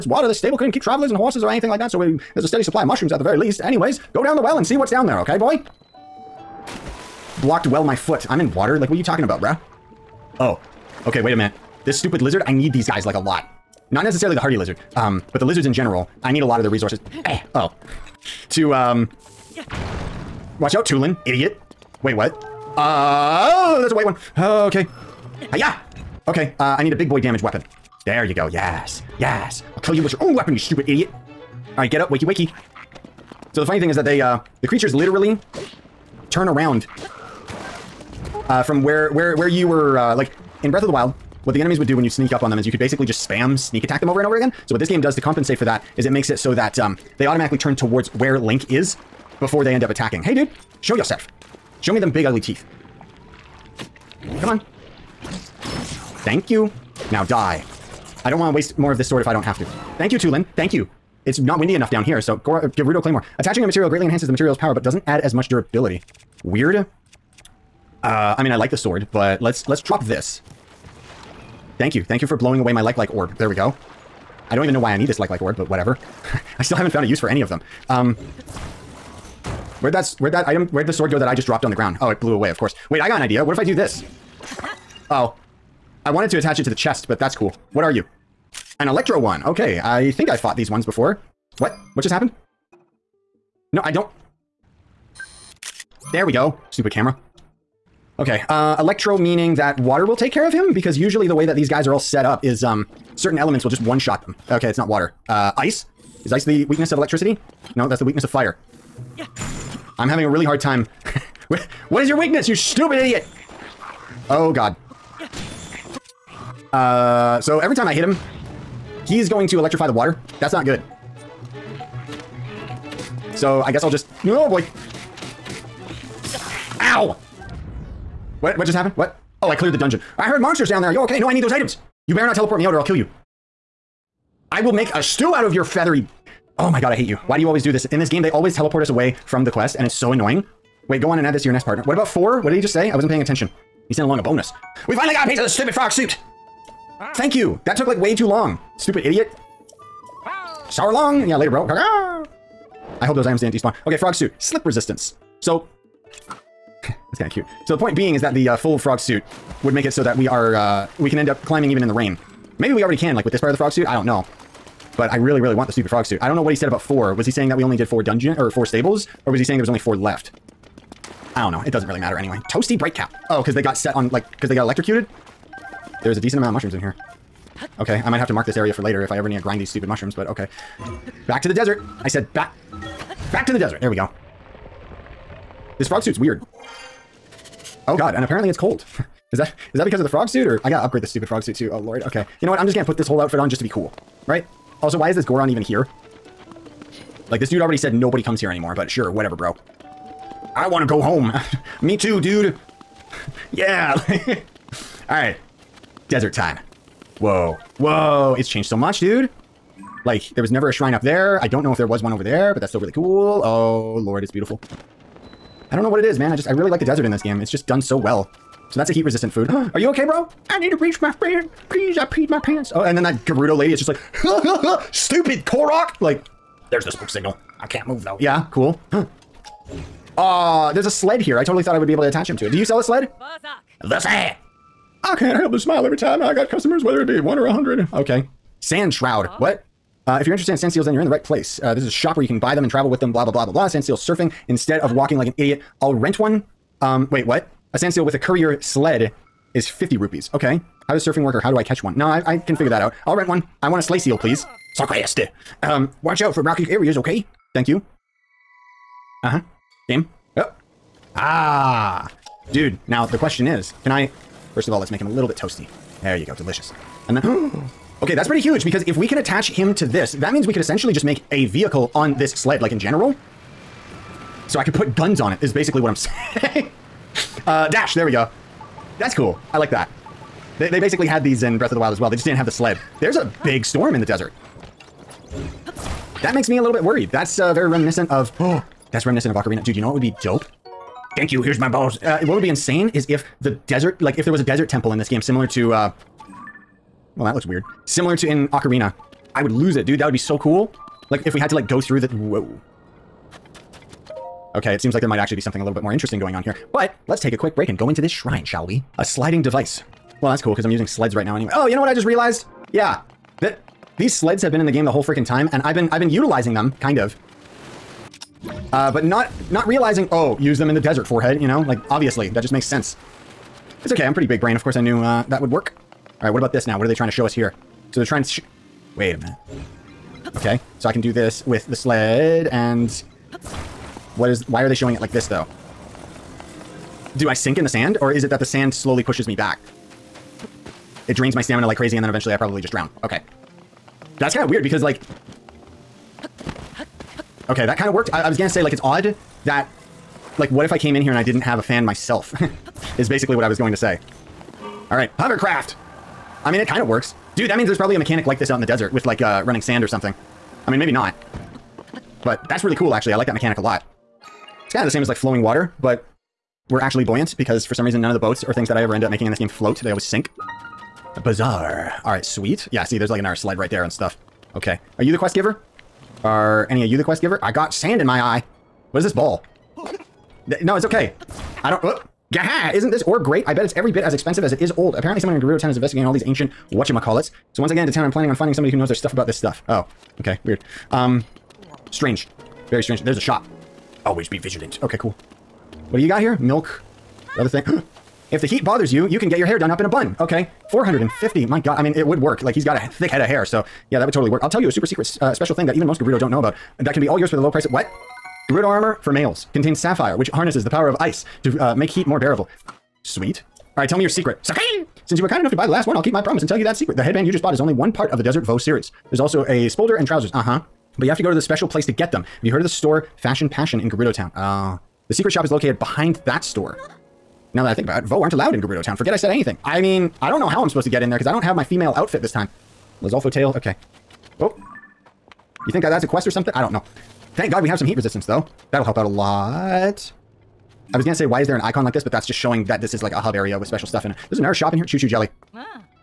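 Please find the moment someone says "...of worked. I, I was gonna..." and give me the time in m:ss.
5:47.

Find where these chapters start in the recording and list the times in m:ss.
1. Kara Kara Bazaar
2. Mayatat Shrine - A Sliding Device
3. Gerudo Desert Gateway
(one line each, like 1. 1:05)
1. 6:10
2. 5:08
3. 3:29.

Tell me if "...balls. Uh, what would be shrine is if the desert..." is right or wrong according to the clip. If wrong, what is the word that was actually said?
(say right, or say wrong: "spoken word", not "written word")
wrong: "insane", not "shrine".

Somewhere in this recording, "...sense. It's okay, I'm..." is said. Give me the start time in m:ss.
5:22.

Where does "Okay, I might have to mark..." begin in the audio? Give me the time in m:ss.
2:57.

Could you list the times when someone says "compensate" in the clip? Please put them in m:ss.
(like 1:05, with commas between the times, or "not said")
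0:45.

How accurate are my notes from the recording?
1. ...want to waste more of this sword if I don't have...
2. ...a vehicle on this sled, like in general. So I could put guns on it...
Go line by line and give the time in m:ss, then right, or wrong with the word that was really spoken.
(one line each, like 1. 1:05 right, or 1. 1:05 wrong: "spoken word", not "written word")
1. 0:58 right
2. 4:31 right.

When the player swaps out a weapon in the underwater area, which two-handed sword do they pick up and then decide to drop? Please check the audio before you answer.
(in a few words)
Gerudo Claymore.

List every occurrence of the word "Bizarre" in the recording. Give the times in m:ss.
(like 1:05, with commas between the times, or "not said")
6:11.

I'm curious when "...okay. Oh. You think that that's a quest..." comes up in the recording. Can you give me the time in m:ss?
7:13.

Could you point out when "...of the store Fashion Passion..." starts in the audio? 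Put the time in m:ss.
7:02.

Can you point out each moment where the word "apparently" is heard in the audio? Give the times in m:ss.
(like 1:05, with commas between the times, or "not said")
3:08, 6:24.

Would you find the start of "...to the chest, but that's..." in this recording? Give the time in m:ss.
1:26.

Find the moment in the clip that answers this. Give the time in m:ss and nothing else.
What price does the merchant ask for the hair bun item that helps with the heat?
6:40.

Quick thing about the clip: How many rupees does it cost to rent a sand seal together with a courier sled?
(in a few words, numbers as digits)
50.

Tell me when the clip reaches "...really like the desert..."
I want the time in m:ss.
3:36.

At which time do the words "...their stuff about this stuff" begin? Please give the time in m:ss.
6:28.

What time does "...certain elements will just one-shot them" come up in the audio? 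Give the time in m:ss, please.
1:43.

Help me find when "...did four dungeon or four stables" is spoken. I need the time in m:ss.
2:47.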